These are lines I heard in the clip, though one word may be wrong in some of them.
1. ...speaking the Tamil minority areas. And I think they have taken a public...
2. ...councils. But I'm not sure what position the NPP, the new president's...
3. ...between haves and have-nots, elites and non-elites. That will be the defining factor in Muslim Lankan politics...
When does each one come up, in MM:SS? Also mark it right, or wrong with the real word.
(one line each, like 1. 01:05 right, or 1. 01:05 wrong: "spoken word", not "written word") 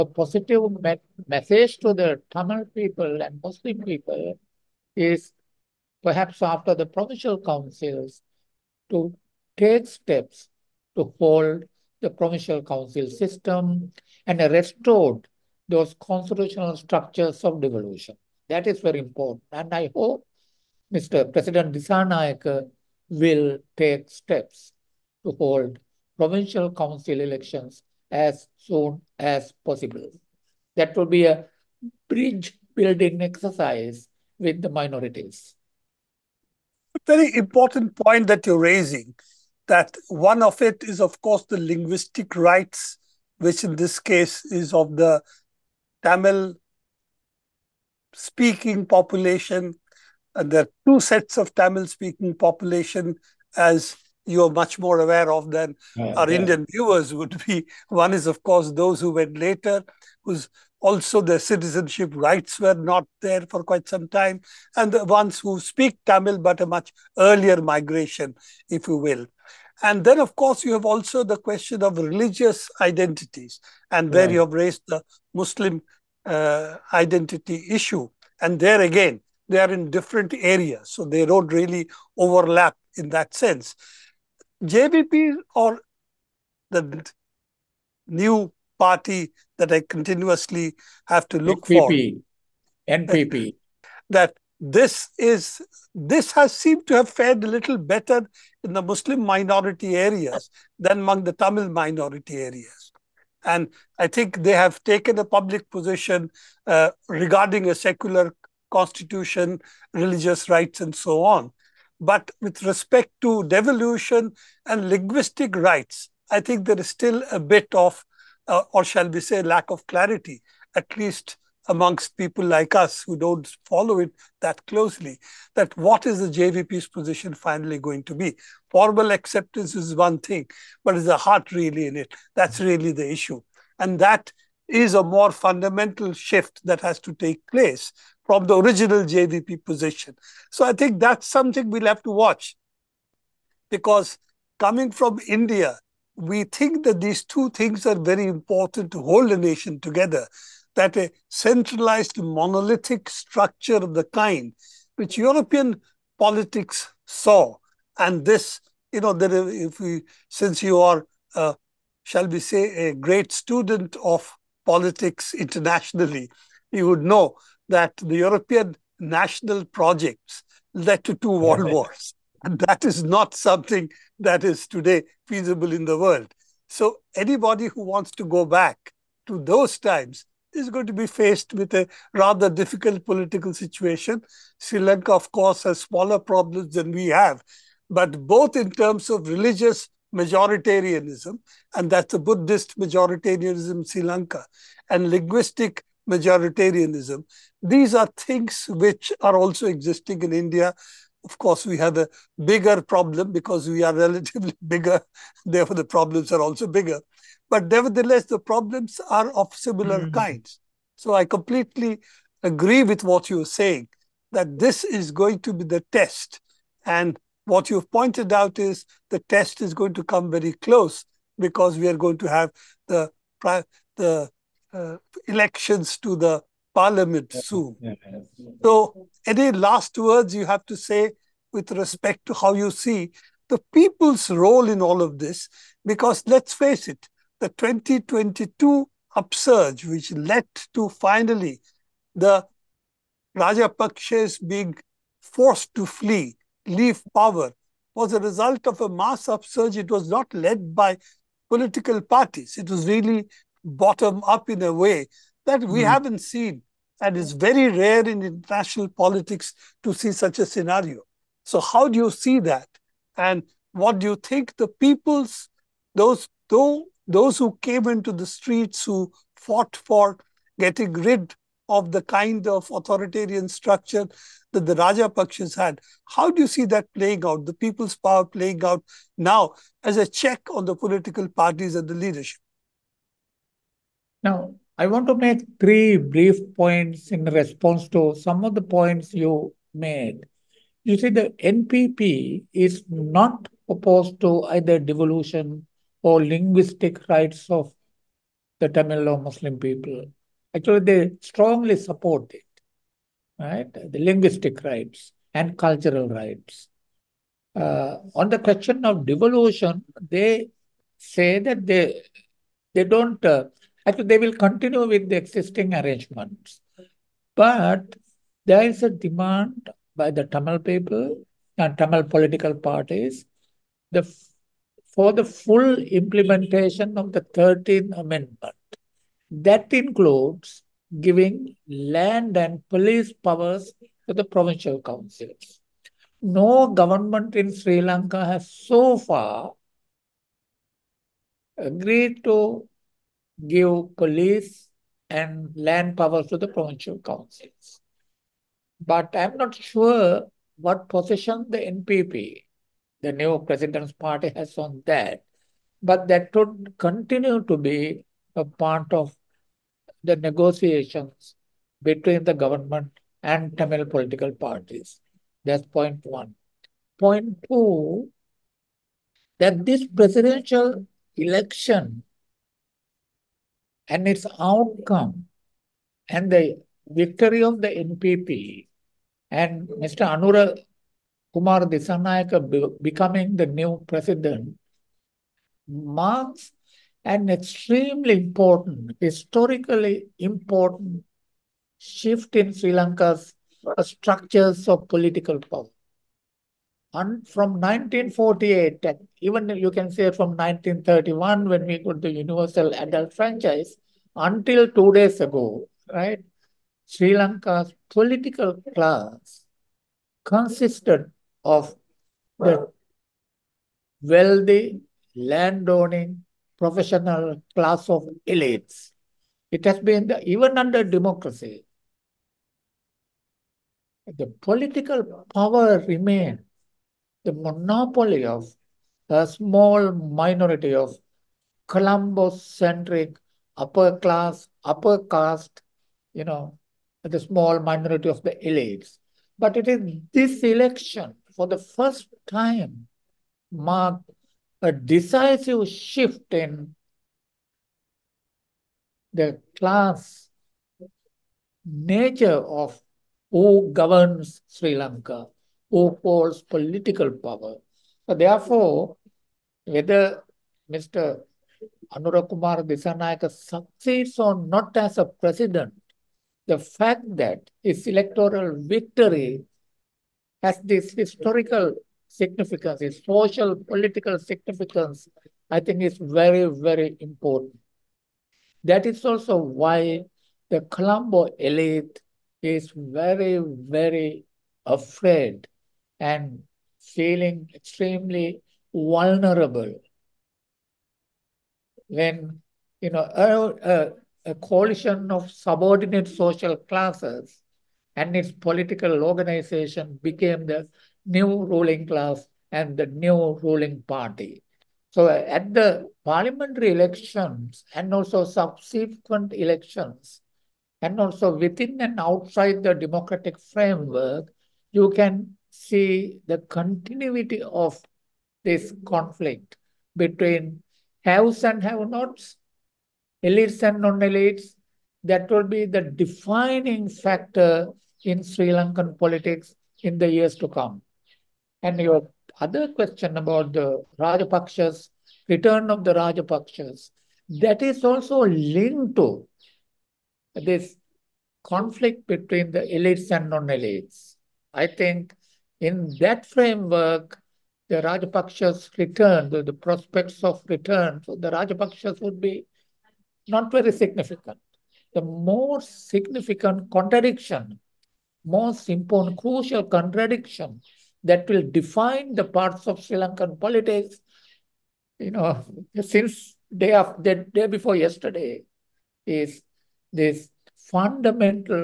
1. 01:40 wrong: "among", not "speaking"
2. 05:46 right
3. 08:40 wrong: "Sri", not "Muslim".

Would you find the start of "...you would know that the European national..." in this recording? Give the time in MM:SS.
02:46.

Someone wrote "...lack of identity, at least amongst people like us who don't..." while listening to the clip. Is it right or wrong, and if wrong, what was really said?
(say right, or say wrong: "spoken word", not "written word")
wrong: "clarity", not "identity".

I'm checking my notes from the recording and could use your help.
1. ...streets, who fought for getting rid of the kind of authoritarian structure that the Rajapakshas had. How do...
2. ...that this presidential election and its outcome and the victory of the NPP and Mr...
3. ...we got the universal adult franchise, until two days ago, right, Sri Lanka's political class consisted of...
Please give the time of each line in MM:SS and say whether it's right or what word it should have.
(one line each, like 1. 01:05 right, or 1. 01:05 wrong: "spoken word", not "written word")
1. 04:28 right
2. 06:09 right
3. 06:41 right.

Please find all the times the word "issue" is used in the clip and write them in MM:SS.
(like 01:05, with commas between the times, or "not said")
01:17, 02:13.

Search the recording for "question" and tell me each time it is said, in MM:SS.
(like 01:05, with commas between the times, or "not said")
01:11, 05:08, 08:52.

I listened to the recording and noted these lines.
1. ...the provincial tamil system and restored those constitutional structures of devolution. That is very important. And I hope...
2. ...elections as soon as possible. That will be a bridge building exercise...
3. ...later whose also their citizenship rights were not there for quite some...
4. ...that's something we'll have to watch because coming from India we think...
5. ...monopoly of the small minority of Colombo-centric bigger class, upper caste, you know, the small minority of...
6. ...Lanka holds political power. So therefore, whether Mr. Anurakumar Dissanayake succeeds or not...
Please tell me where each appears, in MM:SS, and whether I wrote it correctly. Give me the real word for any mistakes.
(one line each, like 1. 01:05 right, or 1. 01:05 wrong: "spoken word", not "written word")
1. 00:11 wrong: "council", not "tamil"
2. 00:27 right
3. 00:59 right
4. 02:20 right
5. 07:07 wrong: "upper", not "bigger"
6. 07:34 right.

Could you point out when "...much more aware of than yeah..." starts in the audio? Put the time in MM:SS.
00:54.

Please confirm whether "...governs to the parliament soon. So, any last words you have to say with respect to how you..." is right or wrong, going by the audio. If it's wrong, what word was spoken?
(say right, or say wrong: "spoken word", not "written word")
wrong: "elections", not "governs".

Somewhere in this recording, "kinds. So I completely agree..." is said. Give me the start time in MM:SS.
03:30.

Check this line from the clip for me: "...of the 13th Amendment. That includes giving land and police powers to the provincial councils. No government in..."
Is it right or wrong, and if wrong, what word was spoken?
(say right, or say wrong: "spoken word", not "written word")
right.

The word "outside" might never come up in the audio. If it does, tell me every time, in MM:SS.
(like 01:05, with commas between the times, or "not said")
08:31.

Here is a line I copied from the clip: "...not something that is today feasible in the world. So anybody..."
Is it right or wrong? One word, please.
right.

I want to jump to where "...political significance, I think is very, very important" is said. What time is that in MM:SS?
07:53.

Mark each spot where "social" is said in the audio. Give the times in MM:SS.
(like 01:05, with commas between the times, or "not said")
07:53, 08:16.